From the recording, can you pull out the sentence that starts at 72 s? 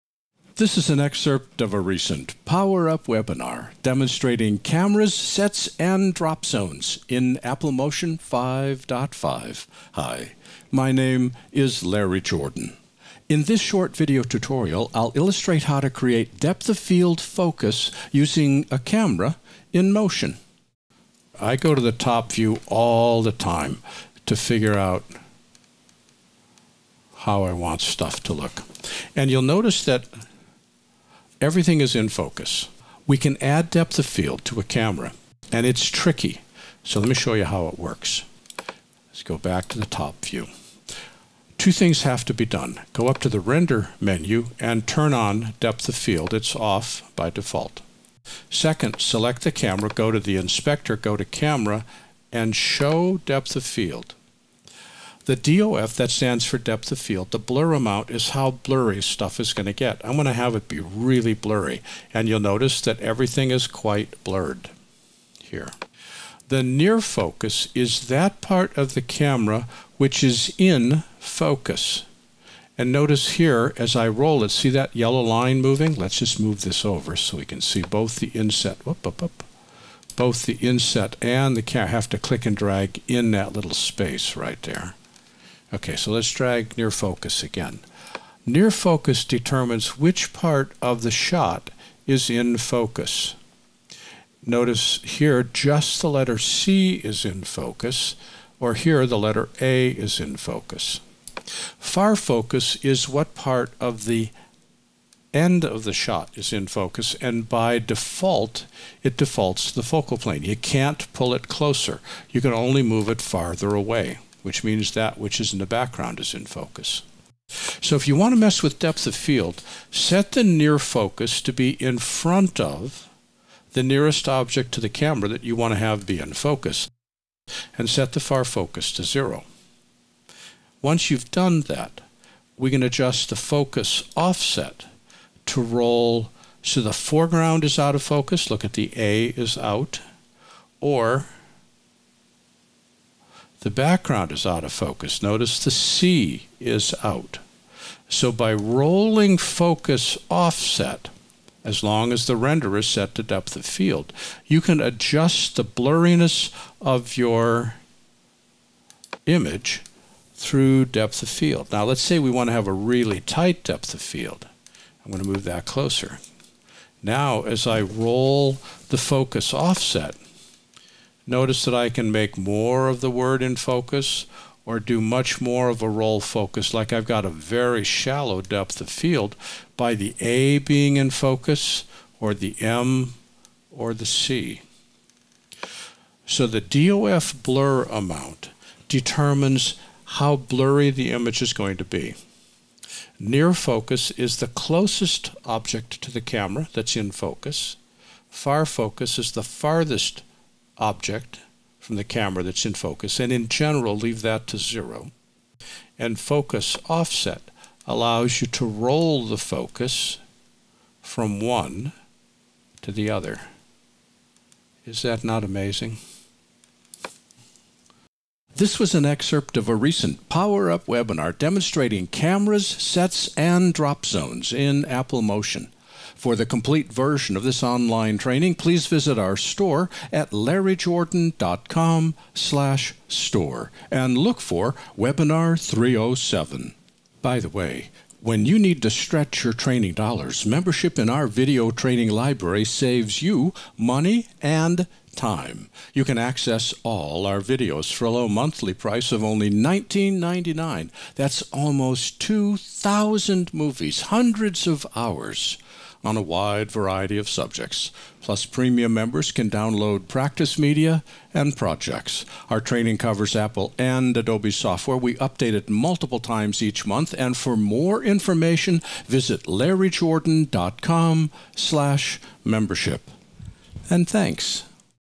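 And notice here, as I roll it, see that yellow line moving?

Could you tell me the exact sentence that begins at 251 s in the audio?
That's almost 2,000 movies, hundreds of hours on a wide variety of subjects.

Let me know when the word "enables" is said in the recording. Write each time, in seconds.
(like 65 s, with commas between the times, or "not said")
not said.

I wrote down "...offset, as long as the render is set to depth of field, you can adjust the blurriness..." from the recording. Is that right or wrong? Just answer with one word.
right.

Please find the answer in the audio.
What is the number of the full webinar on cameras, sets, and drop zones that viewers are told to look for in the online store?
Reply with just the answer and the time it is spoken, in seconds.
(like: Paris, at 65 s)
307, at 234 s.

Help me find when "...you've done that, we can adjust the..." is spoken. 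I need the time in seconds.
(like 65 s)
131 s.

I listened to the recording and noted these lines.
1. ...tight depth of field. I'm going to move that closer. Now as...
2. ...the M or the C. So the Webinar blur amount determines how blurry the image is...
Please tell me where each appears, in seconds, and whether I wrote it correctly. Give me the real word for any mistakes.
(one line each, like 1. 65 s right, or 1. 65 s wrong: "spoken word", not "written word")
1. 163 s right
2. 182 s wrong: "DOF", not "Webinar".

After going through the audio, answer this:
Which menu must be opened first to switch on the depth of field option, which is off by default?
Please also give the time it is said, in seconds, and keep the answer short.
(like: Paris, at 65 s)
Render menu, at 43 s.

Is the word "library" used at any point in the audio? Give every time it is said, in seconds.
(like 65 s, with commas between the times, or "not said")
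242 s.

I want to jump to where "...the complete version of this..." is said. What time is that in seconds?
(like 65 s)
226 s.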